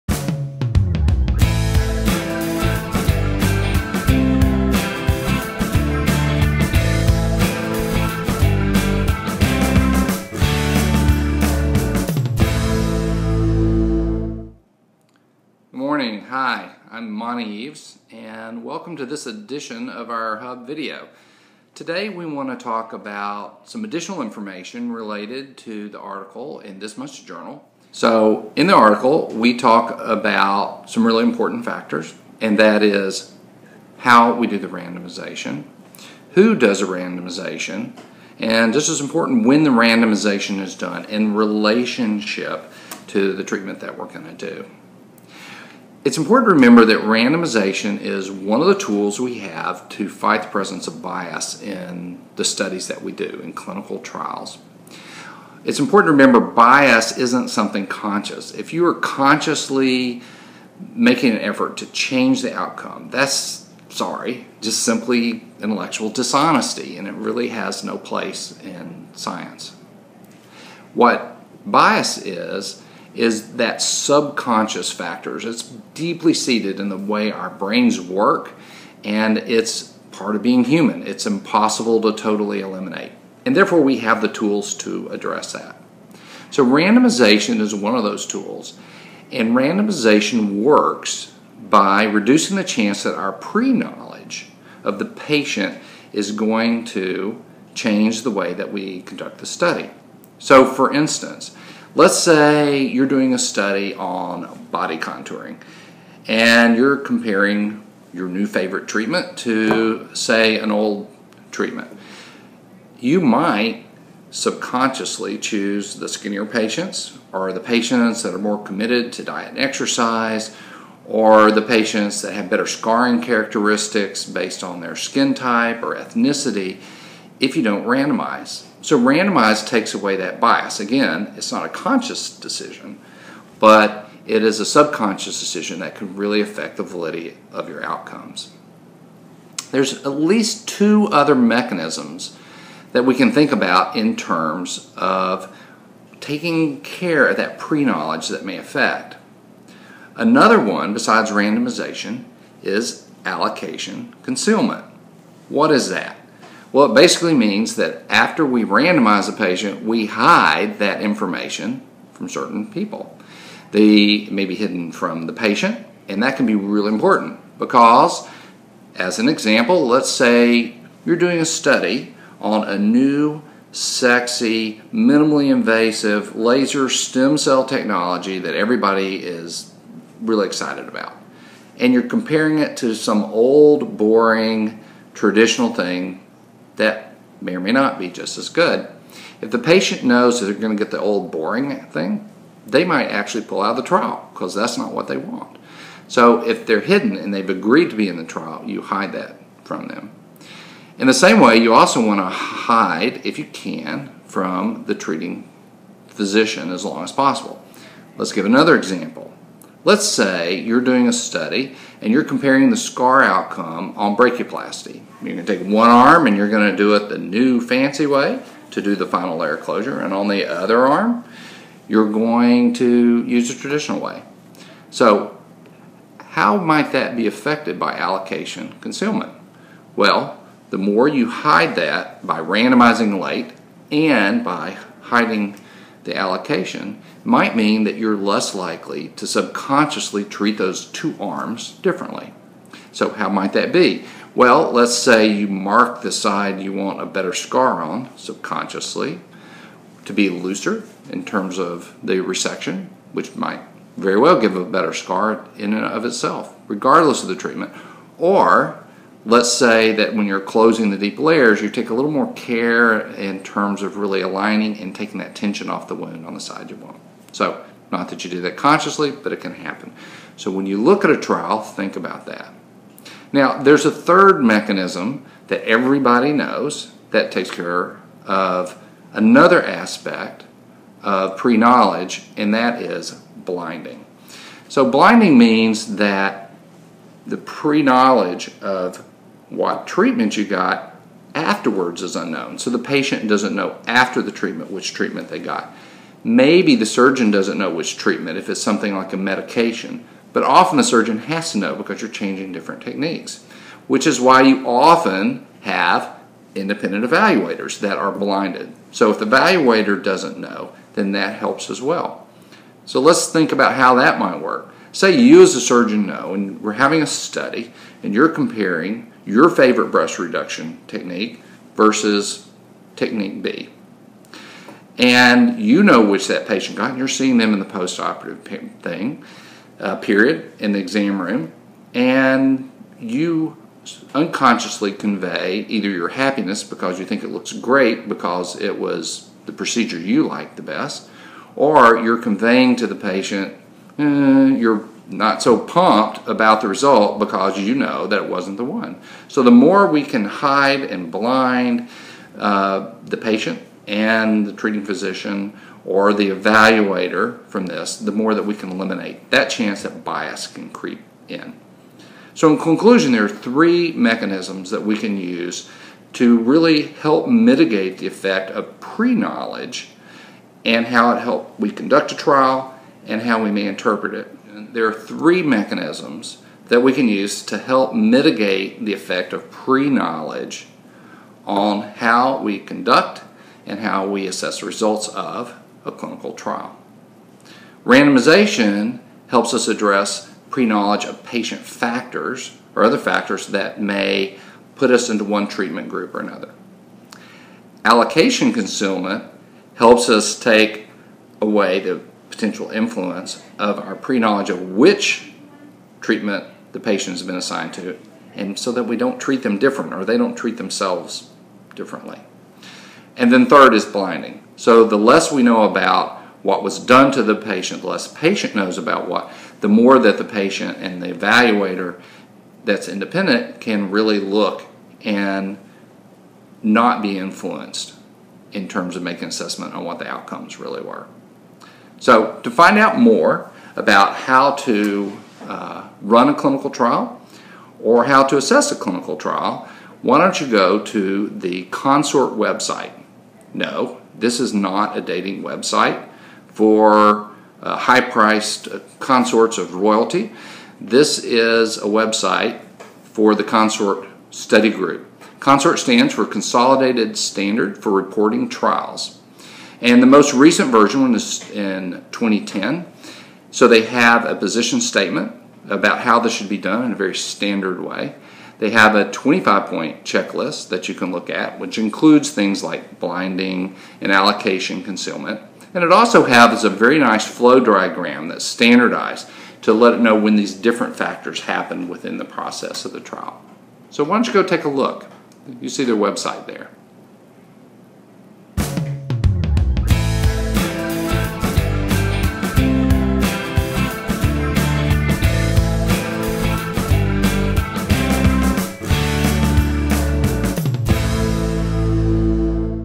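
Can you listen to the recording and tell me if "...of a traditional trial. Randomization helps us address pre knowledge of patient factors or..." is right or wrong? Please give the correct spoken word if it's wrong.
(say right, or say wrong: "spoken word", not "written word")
wrong: "clinical", not "traditional".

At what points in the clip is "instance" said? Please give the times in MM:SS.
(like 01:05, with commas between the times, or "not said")
01:40.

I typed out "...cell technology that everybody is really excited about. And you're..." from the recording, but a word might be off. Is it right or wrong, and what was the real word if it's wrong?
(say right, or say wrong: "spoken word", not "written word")
right.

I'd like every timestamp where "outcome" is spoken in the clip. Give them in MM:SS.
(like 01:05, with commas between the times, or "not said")
01:02, 02:17, 03:33, 07:10.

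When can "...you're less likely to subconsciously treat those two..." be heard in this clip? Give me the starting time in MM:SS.
03:57.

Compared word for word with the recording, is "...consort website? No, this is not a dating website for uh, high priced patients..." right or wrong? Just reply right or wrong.
wrong.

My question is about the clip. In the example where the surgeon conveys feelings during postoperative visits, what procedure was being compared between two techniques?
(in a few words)
breast reduction.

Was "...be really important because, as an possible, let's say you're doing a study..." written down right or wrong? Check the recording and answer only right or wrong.
wrong.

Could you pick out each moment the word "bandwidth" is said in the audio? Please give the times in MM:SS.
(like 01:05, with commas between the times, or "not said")
not said.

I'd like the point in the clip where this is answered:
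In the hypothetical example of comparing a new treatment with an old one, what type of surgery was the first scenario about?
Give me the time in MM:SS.
01:44.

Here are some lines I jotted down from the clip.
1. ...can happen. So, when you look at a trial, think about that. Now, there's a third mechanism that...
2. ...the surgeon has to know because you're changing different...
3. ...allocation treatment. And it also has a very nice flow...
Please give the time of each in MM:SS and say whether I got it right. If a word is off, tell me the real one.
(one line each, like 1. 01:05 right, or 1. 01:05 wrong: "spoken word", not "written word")
1. 04:29 right
2. 05:00 right
3. 07:54 wrong: "concealment", not "treatment".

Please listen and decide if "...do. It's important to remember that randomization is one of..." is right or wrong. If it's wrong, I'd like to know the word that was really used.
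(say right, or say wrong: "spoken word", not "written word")
right.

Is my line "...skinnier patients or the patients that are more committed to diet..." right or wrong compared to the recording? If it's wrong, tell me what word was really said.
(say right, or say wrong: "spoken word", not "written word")
right.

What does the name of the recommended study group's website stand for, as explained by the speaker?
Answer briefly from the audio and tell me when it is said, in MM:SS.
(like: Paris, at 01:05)
Consolidated Standard for Reporting Trials, at 07:36.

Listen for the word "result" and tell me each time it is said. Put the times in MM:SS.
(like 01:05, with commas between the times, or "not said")
05:46, 06:24.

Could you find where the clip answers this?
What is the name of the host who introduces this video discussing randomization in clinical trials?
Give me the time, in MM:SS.
00:17.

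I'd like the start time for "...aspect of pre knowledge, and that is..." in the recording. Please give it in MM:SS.
04:39.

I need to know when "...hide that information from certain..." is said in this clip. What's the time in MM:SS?
02:40.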